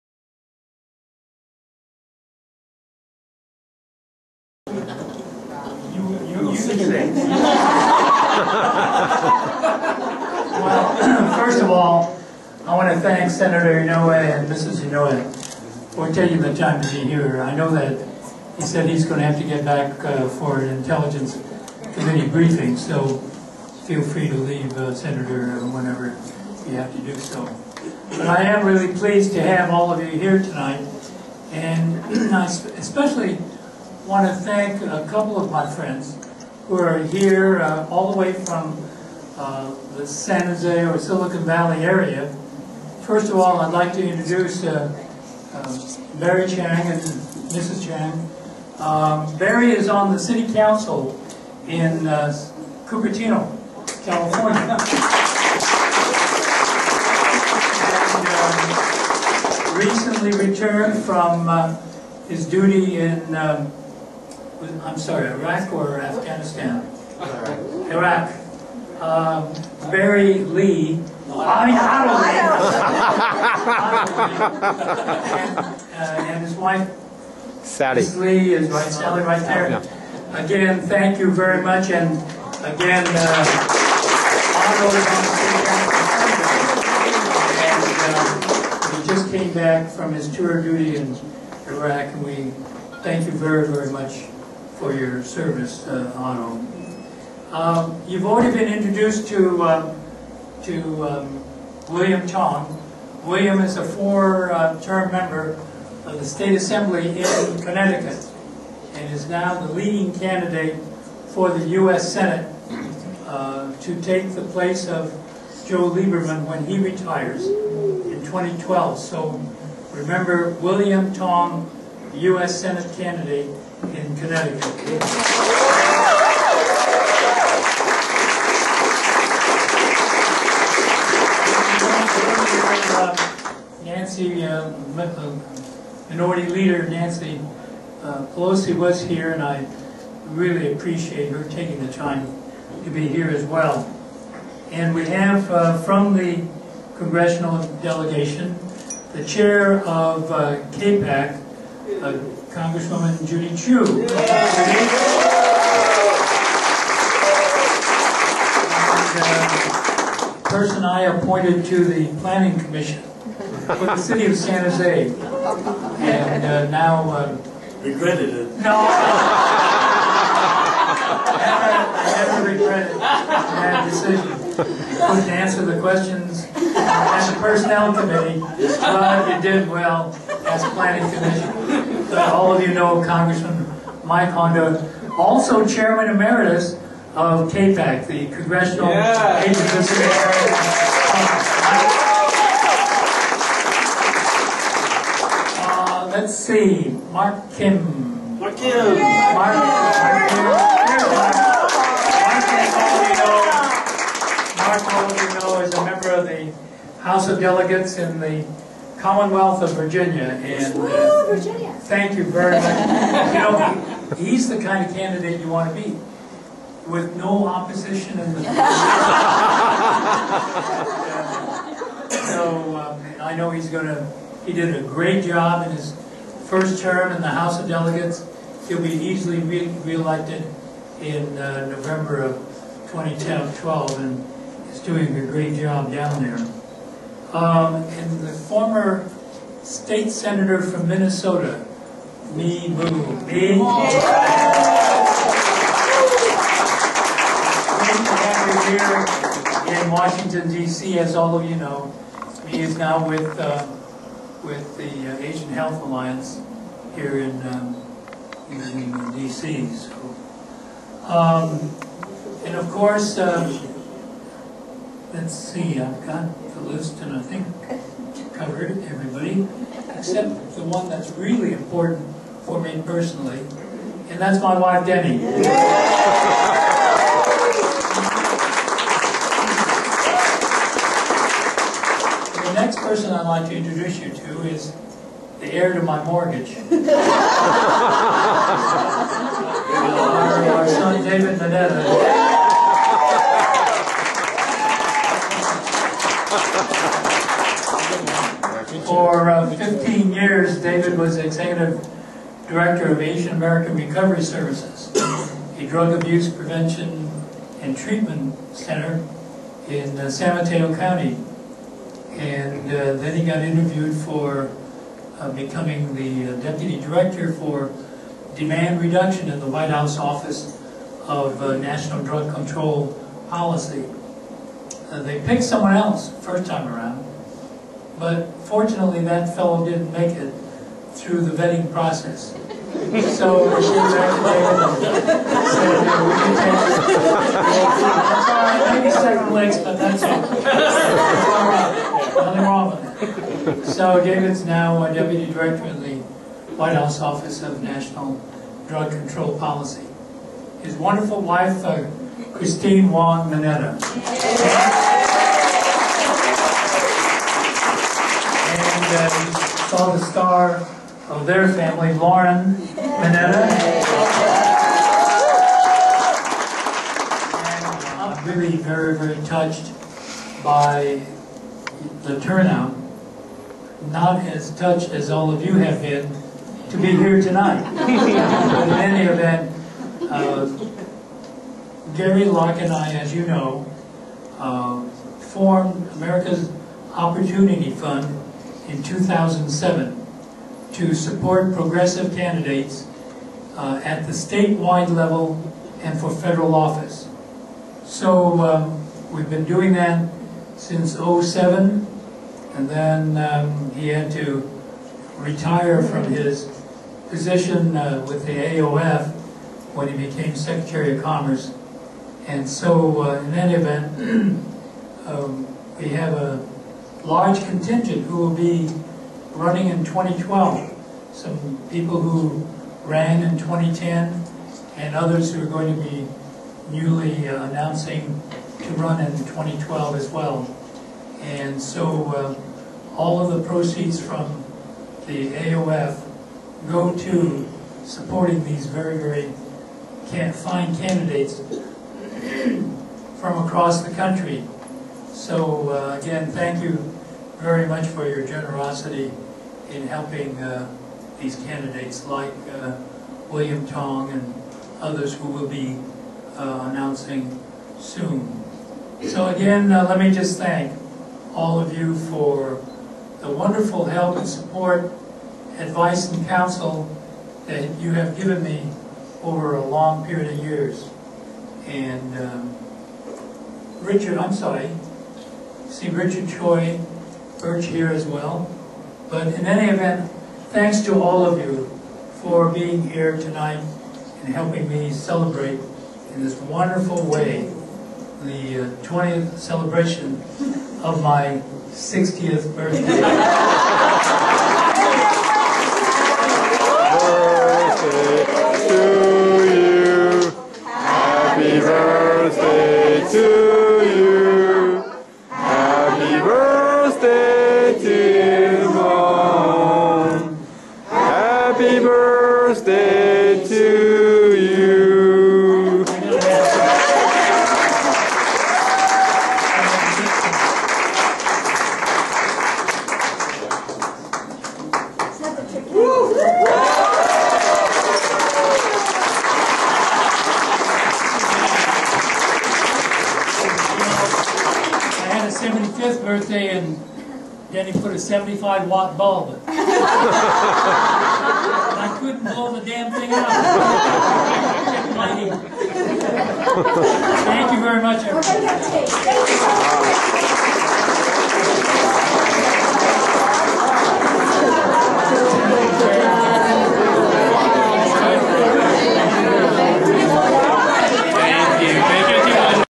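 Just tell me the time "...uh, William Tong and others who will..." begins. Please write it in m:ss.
7:32.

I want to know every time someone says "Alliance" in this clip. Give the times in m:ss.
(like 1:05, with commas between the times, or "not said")
4:15.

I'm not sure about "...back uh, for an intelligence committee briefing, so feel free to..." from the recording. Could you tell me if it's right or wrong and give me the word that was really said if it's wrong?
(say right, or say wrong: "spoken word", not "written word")
right.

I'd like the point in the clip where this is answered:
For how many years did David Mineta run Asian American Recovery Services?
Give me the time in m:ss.
4:59.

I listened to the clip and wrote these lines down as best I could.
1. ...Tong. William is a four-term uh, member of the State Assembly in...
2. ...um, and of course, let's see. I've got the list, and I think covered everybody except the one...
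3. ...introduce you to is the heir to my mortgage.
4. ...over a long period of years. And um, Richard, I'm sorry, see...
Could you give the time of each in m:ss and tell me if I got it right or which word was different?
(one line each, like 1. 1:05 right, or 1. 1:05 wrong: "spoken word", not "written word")
1. 1:42 right
2. 4:21 right
3. 4:43 right
4. 7:49 right.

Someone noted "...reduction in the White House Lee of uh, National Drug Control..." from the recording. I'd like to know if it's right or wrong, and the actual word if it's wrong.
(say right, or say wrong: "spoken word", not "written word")
wrong: "Office", not "Lee".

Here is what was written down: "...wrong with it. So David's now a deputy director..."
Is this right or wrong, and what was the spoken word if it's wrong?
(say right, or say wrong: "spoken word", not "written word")
right.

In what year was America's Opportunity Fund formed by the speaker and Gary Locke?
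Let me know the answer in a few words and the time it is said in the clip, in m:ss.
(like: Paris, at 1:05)
2007, at 6:28.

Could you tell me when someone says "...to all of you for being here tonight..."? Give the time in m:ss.
8:00.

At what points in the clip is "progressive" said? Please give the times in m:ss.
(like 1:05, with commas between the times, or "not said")
6:31.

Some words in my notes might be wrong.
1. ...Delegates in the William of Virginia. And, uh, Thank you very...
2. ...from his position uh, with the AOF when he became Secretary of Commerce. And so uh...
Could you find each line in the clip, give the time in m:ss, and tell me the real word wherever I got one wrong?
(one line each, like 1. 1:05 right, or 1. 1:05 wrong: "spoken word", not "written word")
1. 3:27 wrong: "Commonwealth", not "William"
2. 6:45 right.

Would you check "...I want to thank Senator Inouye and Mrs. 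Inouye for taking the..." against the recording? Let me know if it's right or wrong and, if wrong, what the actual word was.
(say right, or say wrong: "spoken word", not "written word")
right.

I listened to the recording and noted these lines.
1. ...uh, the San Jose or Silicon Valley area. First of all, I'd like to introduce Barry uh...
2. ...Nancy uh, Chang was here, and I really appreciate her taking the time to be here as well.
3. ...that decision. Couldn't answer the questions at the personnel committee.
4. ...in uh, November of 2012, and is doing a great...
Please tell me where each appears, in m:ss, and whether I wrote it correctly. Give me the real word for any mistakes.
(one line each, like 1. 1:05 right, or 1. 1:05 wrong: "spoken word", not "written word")
1. 0:39 right
2. 2:16 wrong: "Pelosi", not "Chang"
3. 2:52 right
4. 3:51 right.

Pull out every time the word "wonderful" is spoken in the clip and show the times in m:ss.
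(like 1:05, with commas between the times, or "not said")
5:50, 7:43, 8:06.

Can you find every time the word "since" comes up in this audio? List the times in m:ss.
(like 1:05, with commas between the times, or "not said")
6:40.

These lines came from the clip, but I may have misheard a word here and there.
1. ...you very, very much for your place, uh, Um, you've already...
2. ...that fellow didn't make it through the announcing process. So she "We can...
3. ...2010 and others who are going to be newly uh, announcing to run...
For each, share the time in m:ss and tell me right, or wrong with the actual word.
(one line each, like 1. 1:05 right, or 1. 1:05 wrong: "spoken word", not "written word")
1. 1:33 wrong: "service", not "place"
2. 5:29 wrong: "vetting", not "announcing"
3. 7:03 right.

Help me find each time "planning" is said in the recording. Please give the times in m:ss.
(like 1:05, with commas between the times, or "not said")
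2:42, 3:00.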